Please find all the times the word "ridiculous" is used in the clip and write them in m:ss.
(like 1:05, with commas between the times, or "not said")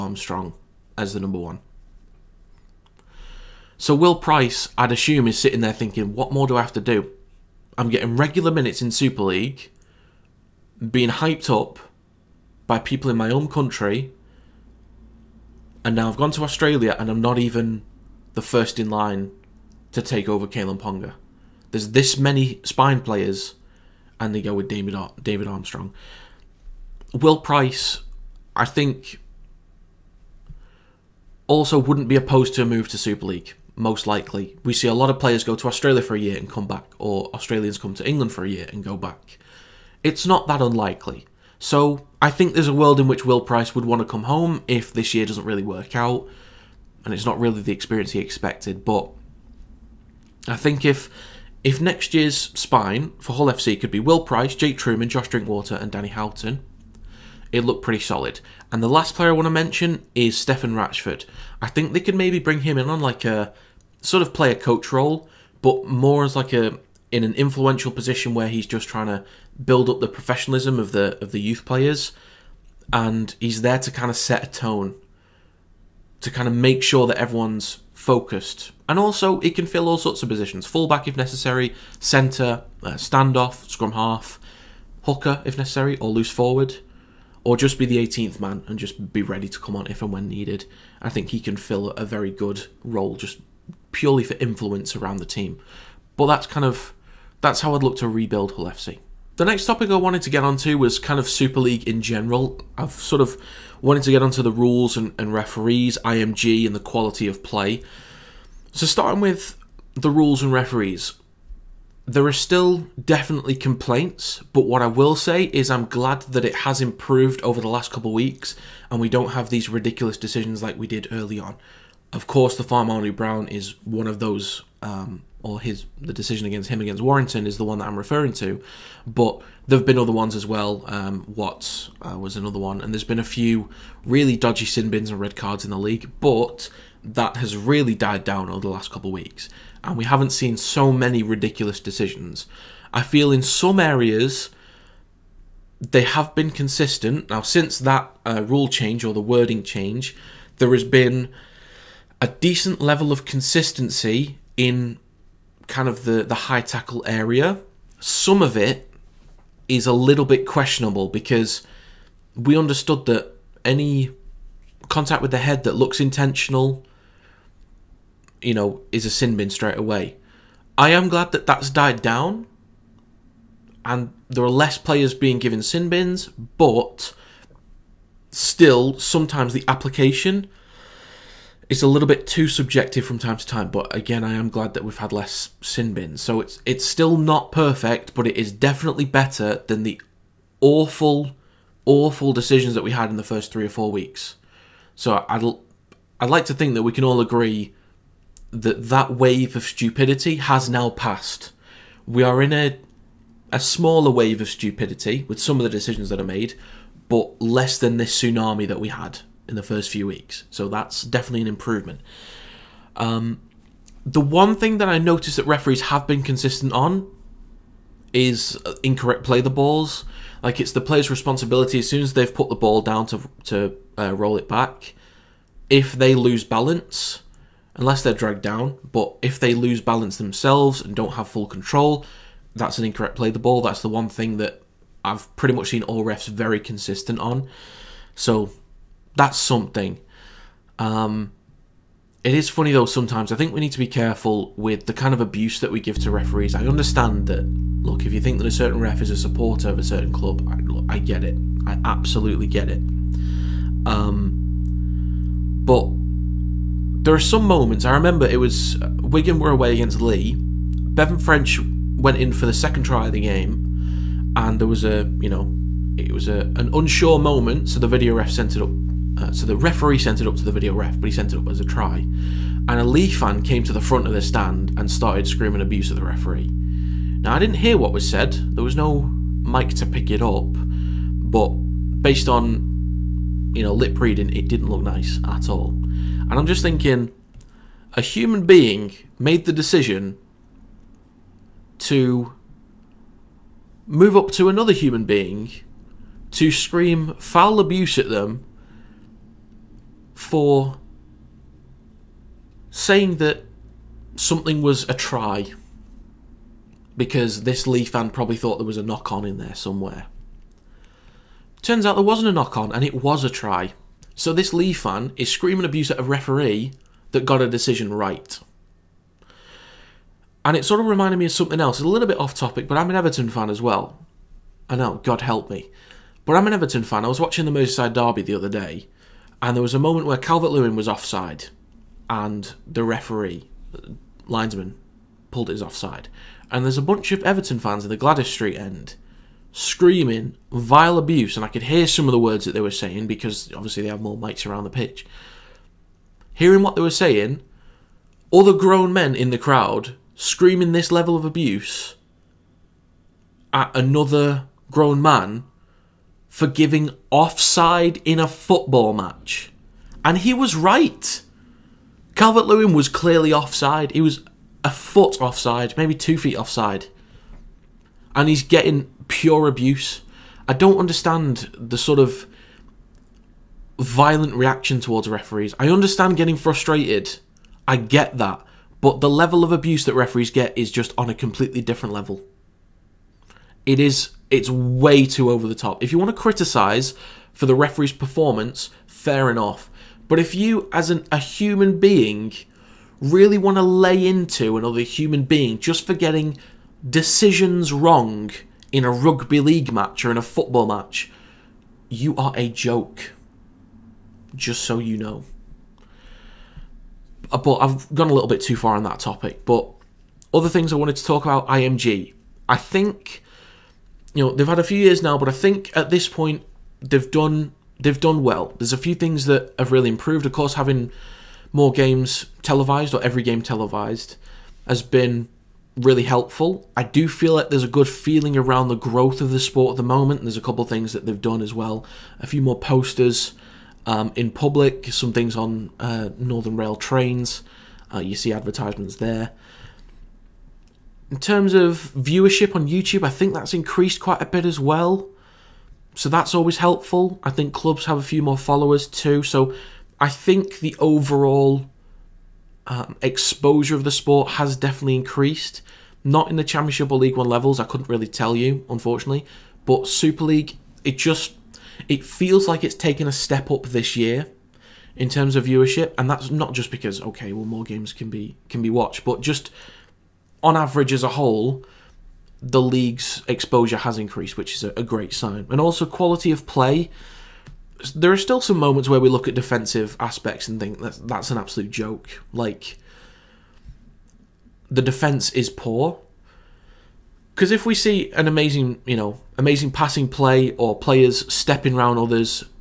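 1:59, 2:21.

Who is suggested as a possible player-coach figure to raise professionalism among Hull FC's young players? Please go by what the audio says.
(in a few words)
Stefan Ratchford.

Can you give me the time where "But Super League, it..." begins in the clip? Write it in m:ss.
7:39.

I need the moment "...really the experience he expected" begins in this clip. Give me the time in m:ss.
0:47.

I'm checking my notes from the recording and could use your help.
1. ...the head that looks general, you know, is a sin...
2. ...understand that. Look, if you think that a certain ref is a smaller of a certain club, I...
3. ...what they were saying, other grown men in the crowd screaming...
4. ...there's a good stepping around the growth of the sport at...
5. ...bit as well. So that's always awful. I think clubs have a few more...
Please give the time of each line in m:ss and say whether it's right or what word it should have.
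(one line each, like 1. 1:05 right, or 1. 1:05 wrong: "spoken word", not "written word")
1. 2:45 wrong: "intentional", not "general"
2. 4:06 wrong: "supporter", not "smaller"
3. 5:46 right
4. 7:07 wrong: "feeling", not "stepping"
5. 7:24 wrong: "helpful", not "awful".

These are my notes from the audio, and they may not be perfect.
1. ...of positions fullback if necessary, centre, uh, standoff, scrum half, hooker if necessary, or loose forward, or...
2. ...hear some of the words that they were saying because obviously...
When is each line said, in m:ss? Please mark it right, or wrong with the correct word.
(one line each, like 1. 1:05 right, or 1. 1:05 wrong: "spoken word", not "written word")
1. 1:20 right
2. 5:41 right.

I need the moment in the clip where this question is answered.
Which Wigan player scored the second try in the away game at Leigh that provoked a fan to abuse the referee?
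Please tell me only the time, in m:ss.
4:20.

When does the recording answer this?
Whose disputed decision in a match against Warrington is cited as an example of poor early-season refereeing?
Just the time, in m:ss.
2:02.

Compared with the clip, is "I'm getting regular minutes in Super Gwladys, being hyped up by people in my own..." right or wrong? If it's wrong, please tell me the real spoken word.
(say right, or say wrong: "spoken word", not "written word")
wrong: "League", not "Gwladys".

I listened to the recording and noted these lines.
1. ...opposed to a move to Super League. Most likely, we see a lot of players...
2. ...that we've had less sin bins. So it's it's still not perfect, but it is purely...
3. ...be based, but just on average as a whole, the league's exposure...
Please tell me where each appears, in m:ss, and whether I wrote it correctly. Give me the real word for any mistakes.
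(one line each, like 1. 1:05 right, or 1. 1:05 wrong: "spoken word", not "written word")
1. 0:32 right
2. 3:04 wrong: "definitely", not "purely"
3. 7:48 wrong: "watched", not "based".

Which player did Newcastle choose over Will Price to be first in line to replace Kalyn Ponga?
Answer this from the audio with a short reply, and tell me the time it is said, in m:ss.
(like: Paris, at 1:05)
David Armstrong, at 0:25.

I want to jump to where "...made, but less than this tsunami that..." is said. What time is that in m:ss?
3:26.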